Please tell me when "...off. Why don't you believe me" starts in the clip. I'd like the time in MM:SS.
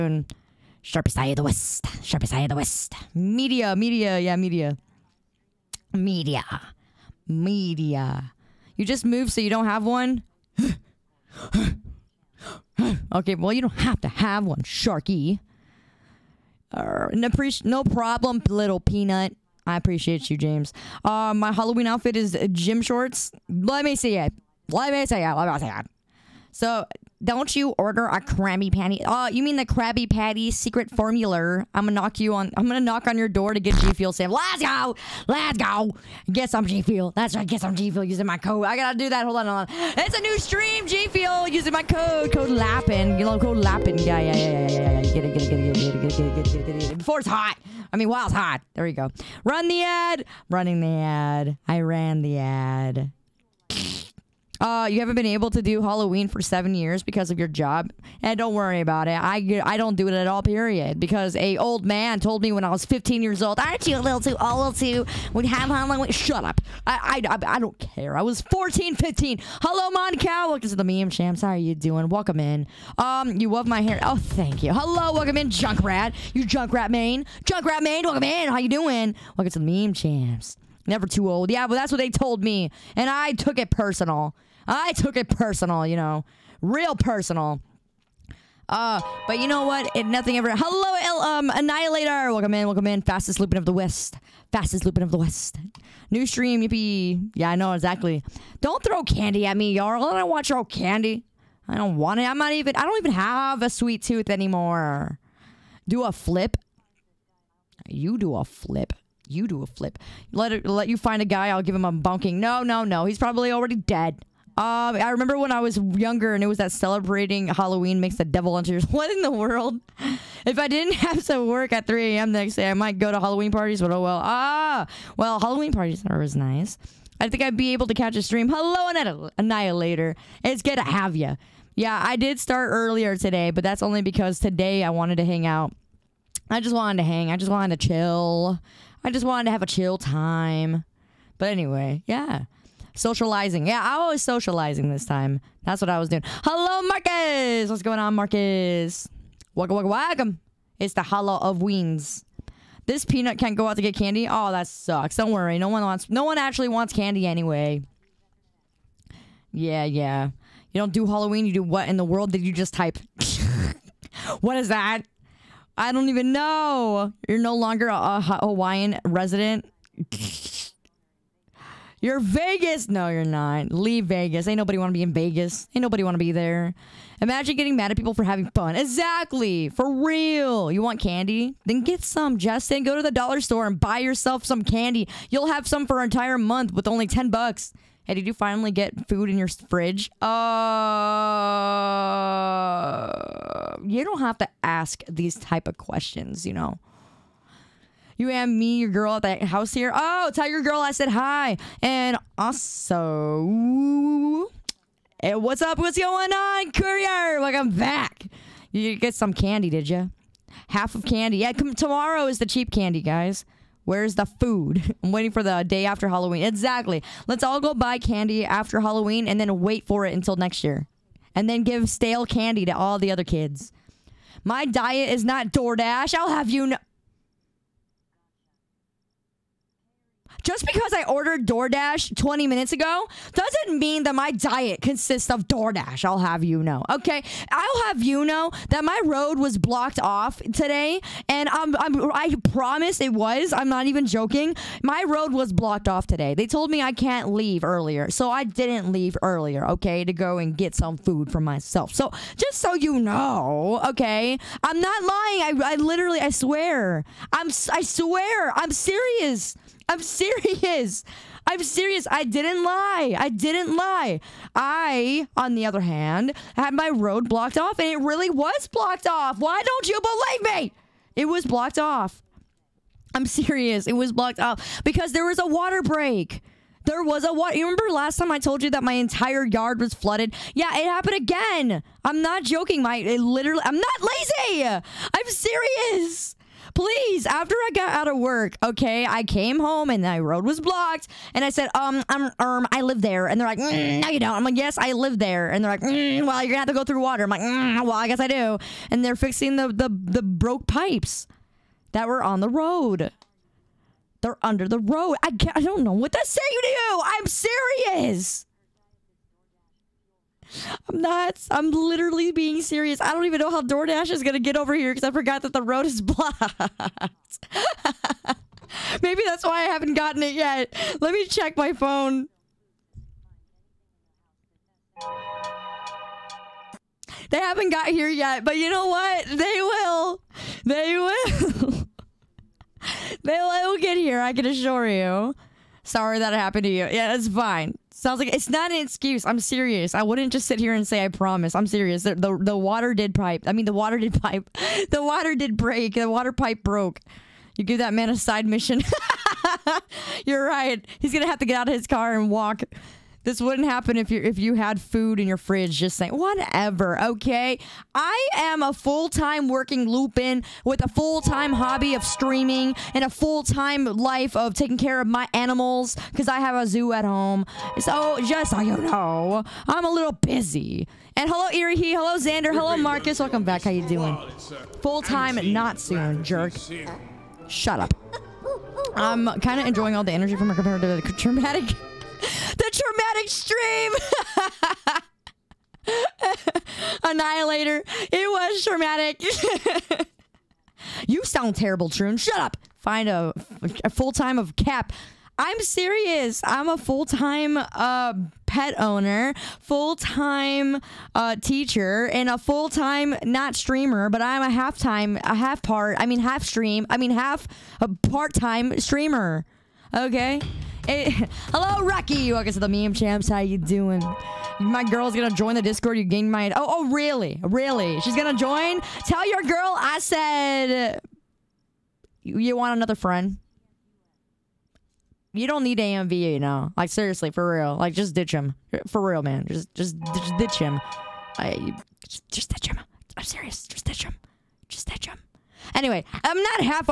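04:29.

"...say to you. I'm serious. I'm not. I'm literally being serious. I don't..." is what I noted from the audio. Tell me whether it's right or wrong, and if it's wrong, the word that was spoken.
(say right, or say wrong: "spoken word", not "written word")
right.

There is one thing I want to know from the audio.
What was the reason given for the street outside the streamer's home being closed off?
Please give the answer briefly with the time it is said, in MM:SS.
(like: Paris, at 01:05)
water break, at 04:35.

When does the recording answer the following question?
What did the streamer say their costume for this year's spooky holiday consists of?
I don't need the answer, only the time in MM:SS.
00:22.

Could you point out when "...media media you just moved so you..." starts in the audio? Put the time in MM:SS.
00:05.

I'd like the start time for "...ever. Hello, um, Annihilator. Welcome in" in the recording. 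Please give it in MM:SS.
01:30.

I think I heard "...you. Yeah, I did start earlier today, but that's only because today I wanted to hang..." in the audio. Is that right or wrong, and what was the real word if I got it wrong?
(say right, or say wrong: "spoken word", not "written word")
right.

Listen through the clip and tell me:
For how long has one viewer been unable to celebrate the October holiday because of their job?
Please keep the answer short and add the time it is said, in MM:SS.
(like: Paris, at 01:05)
7 years, at 00:56.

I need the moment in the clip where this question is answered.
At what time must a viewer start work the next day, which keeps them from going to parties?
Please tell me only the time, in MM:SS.
02:01.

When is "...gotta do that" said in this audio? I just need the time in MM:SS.
00:38.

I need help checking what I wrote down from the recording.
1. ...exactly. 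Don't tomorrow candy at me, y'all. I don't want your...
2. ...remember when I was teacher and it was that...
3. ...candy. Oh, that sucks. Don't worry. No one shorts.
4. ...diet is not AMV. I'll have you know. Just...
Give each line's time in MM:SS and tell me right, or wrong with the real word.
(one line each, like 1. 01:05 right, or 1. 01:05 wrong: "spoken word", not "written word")
1. 01:37 wrong: "throw", not "tomorrow"
2. 01:55 wrong: "younger", not "teacher"
3. 02:33 wrong: "wants", not "shorts"
4. 03:44 wrong: "DoorDash", not "AMV".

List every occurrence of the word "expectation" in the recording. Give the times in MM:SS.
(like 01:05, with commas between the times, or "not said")
not said.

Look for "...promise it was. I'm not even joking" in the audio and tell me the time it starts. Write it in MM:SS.
04:02.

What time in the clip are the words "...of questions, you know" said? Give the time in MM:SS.
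03:15.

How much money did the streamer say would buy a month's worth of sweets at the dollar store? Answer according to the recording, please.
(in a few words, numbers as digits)
10 bucks.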